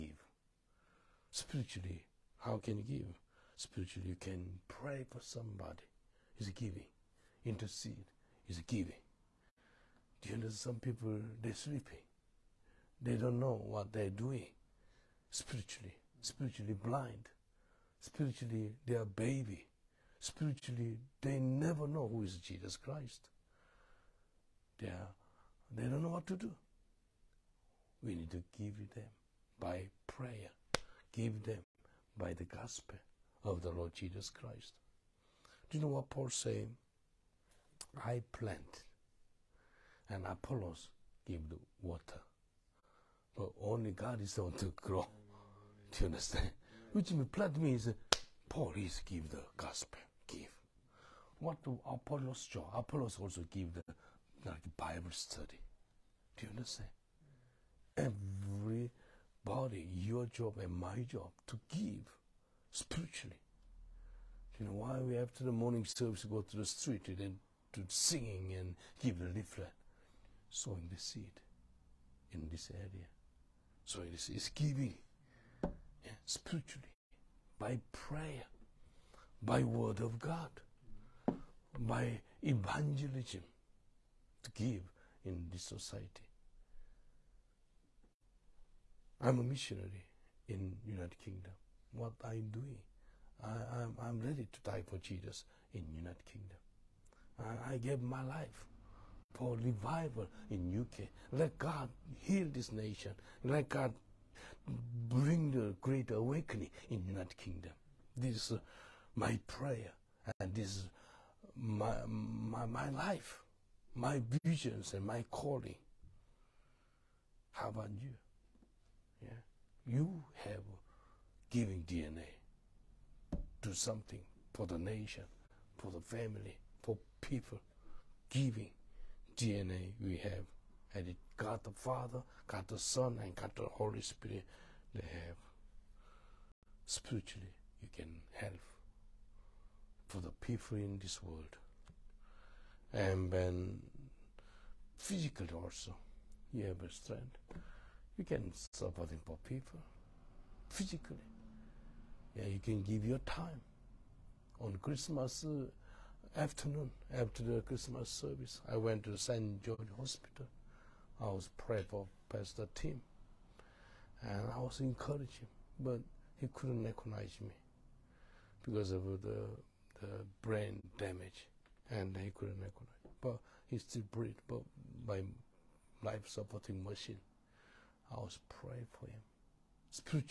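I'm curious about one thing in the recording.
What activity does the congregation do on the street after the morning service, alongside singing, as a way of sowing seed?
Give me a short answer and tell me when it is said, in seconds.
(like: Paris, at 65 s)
give the leaflet, at 69 s.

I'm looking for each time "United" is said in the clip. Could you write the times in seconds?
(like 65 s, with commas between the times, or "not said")
90 s, 95 s, 107 s.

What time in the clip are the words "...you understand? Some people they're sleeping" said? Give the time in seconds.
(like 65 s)
10 s.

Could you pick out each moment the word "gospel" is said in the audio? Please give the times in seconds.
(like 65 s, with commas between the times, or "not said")
32 s, 49 s.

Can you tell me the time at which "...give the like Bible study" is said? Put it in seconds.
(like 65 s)
53 s.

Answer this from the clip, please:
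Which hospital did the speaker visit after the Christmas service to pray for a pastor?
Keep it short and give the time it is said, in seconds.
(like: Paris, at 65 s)
St. George Hospital, at 159 s.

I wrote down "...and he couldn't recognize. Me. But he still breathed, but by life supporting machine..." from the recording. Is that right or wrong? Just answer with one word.
right.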